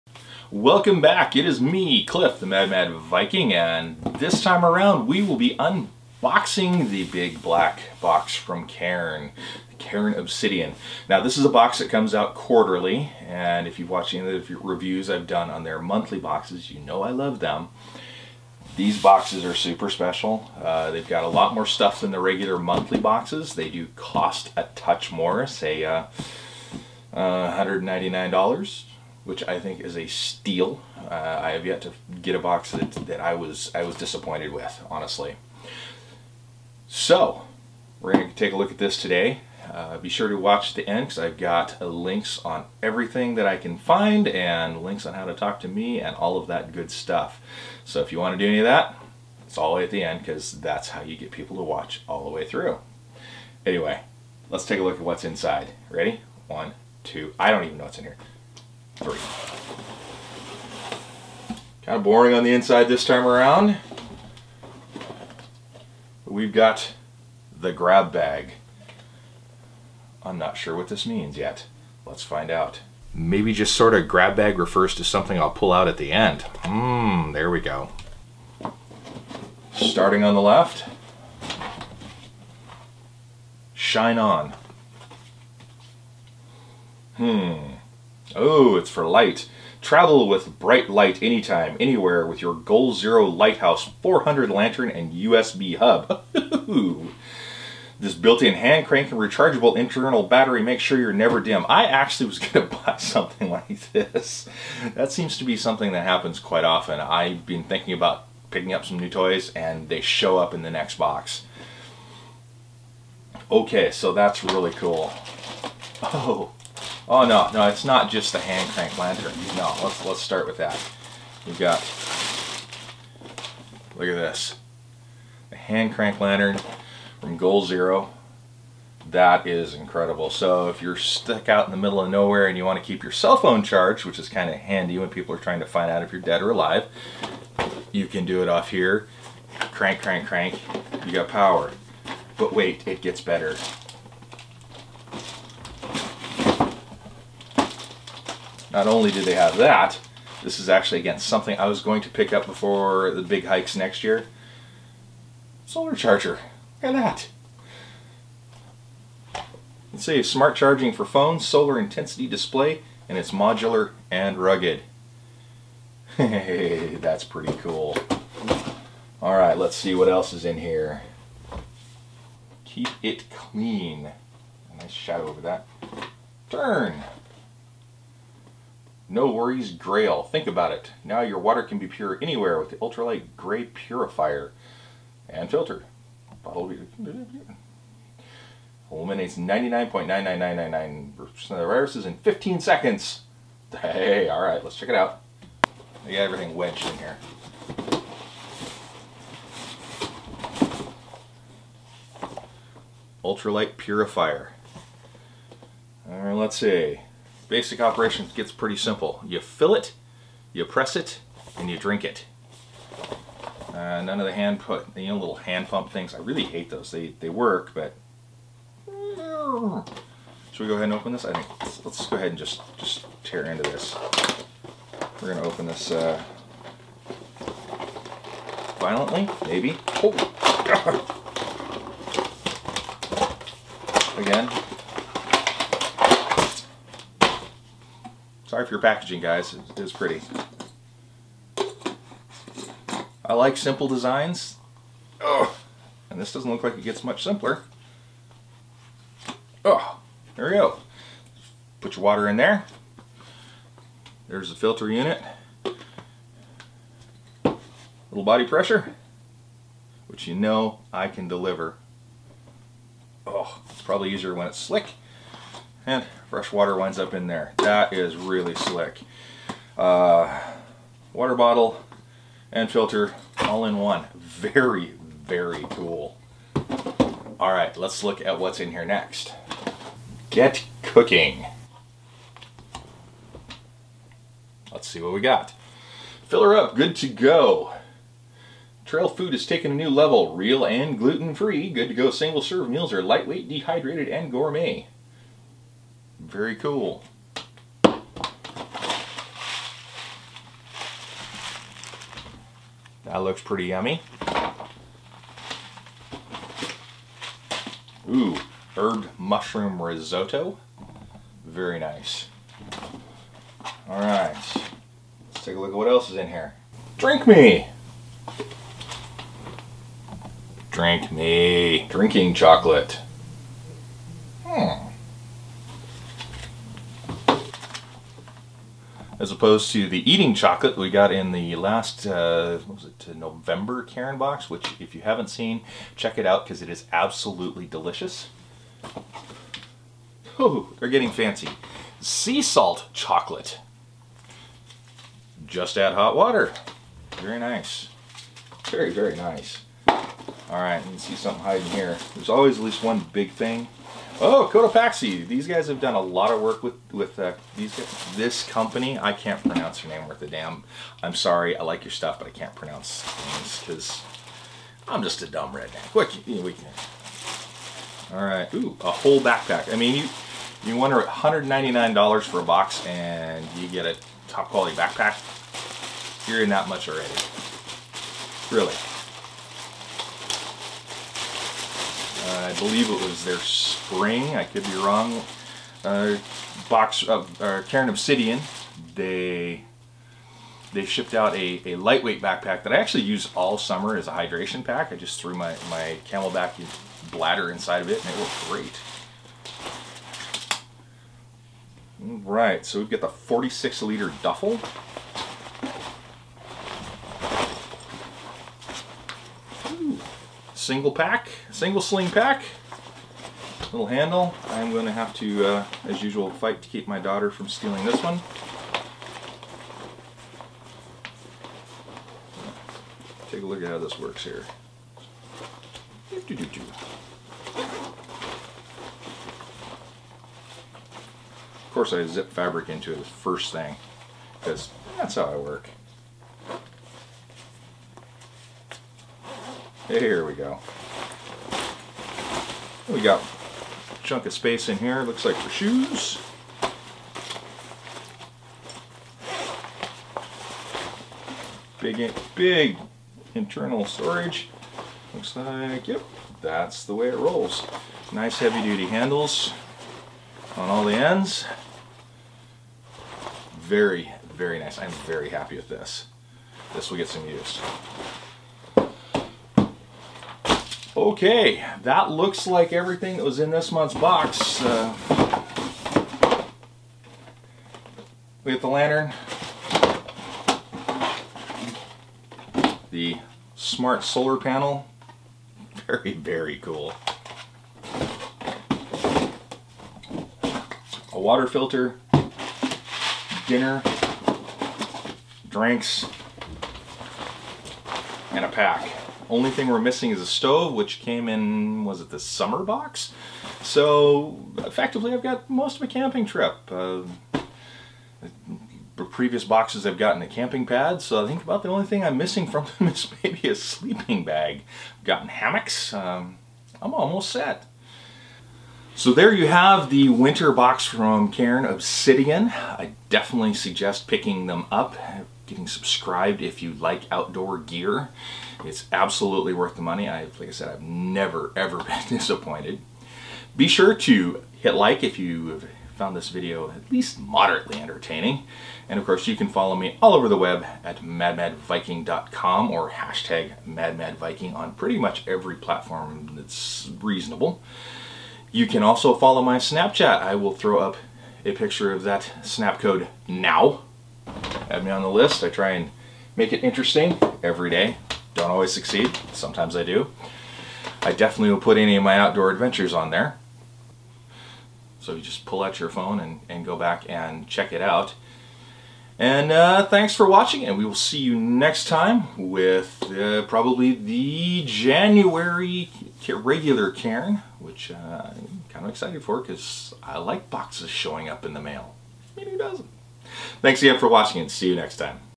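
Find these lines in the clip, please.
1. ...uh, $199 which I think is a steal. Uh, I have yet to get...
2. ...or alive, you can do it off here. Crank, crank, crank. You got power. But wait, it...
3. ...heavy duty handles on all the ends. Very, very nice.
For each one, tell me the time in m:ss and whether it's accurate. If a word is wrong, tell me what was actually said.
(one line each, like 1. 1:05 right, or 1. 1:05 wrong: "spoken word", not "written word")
1. 0:27 right
2. 2:16 right
3. 7:38 right.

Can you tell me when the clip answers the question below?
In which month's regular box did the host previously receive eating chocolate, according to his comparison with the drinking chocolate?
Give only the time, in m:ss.
5:33.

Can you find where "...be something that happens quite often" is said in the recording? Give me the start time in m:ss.
1:45.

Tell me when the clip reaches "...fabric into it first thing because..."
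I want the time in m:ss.
7:12.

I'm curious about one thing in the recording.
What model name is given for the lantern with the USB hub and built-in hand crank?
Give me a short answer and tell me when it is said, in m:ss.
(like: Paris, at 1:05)
Lighthouse 400, at 1:33.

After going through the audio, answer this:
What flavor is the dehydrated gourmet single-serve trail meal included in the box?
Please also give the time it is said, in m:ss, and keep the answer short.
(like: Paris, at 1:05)
Herb mushroom risotto, at 5:08.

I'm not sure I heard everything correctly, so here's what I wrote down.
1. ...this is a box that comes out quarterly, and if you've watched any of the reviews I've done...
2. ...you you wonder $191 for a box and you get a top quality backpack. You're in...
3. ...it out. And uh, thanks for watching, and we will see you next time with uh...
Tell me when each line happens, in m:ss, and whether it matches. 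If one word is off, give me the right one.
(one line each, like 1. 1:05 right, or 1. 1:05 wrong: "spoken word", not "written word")
1. 0:11 right
2. 6:09 wrong: "199", not "191"
3. 9:27 right.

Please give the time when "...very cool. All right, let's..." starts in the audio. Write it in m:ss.
4:35.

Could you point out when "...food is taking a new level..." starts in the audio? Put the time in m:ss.
4:49.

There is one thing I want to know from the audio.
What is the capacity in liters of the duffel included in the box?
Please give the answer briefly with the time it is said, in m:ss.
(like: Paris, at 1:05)
46 liters, at 6:43.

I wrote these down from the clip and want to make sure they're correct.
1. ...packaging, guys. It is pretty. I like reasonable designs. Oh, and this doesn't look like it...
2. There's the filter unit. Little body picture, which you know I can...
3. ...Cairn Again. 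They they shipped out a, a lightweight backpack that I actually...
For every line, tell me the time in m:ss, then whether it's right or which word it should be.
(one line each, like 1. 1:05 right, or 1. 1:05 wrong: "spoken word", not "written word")
1. 3:58 wrong: "simple", not "reasonable"
2. 4:14 wrong: "pressure", not "picture"
3. 6:27 wrong: "Obsidian", not "Again".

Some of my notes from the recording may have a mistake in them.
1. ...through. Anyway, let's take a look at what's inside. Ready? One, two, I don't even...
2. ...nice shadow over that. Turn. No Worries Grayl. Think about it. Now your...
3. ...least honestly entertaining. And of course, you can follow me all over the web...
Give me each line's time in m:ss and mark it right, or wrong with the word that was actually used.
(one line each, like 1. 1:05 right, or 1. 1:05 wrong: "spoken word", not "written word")
1. 0:52 right
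2. 2:54 right
3. 8:56 wrong: "moderately", not "honestly".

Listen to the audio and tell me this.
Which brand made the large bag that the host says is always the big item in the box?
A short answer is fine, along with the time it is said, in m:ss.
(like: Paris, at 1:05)
Cotopaxi, at 5:54.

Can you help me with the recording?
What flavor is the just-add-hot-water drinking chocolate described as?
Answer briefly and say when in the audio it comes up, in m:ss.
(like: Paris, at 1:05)
Sea salt, at 5:41.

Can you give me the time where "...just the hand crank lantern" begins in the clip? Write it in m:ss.
1:58.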